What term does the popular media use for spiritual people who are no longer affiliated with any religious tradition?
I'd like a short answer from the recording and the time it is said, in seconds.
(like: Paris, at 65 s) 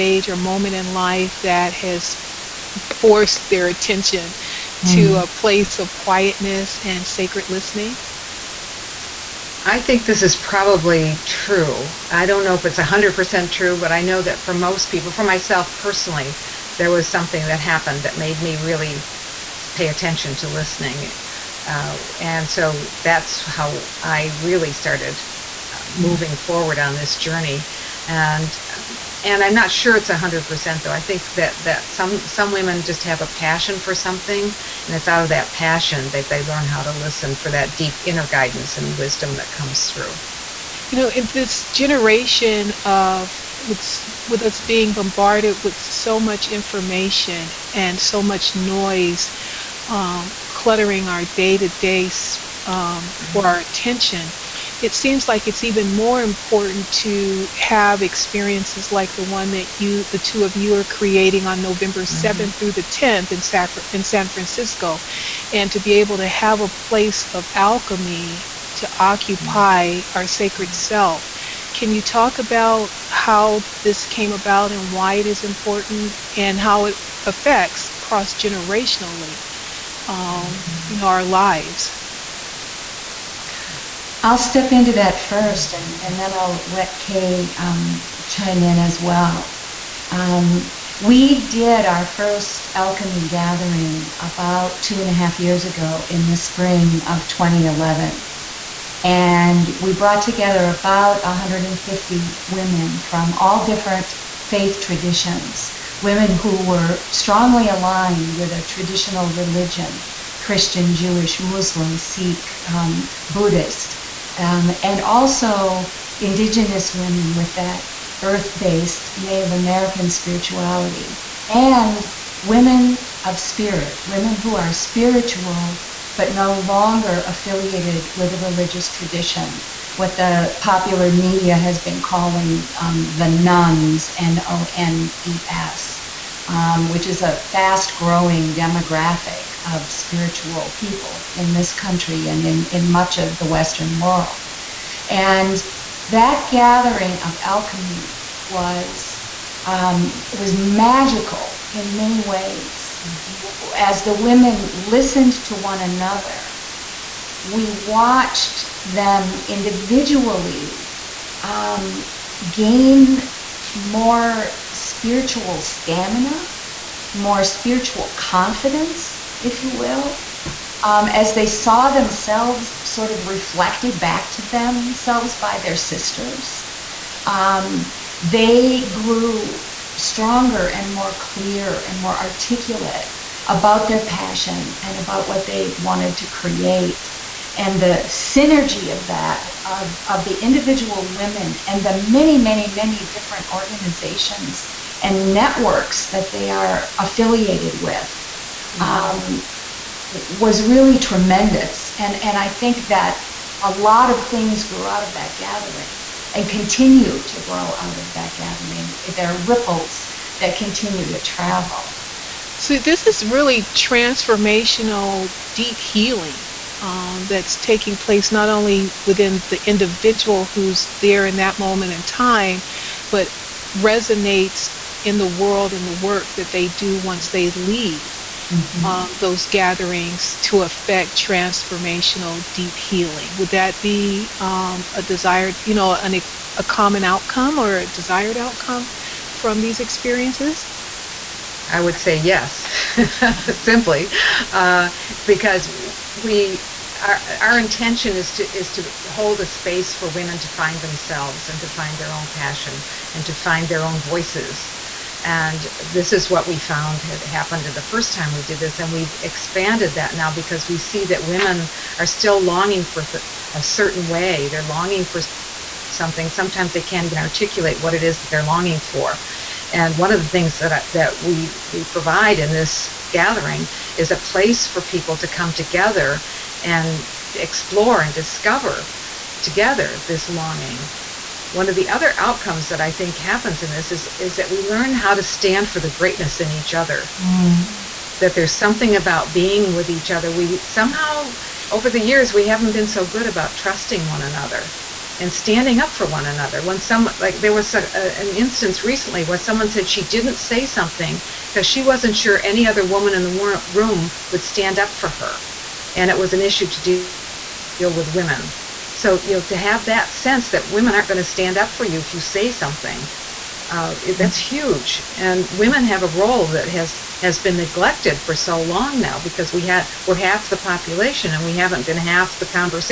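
the nones, at 133 s.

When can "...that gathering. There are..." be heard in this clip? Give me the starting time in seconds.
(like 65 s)
208 s.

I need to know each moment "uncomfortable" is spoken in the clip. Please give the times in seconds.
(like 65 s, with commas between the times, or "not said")
not said.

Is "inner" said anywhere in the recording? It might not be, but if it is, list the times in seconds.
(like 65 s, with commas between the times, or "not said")
38 s.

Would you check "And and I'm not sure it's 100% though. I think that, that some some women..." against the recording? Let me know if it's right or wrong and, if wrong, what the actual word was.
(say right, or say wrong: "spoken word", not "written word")
right.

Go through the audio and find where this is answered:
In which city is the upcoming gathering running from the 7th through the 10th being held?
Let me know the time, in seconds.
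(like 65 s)
64 s.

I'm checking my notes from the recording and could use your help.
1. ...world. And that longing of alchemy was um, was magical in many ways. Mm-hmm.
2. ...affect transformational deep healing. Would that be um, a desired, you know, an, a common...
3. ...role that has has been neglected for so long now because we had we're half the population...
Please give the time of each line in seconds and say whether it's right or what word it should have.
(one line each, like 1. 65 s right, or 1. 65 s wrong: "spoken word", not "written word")
1. 143 s wrong: "gathering", not "longing"
2. 230 s right
3. 316 s right.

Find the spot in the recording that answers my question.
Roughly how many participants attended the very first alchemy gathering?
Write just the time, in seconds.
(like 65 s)
100 s.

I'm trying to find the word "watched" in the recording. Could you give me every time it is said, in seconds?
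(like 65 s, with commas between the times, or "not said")
157 s.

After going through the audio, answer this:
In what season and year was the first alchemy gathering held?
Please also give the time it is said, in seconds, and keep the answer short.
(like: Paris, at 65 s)
spring of 2011, at 96 s.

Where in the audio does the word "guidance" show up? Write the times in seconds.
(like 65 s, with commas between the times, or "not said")
38 s.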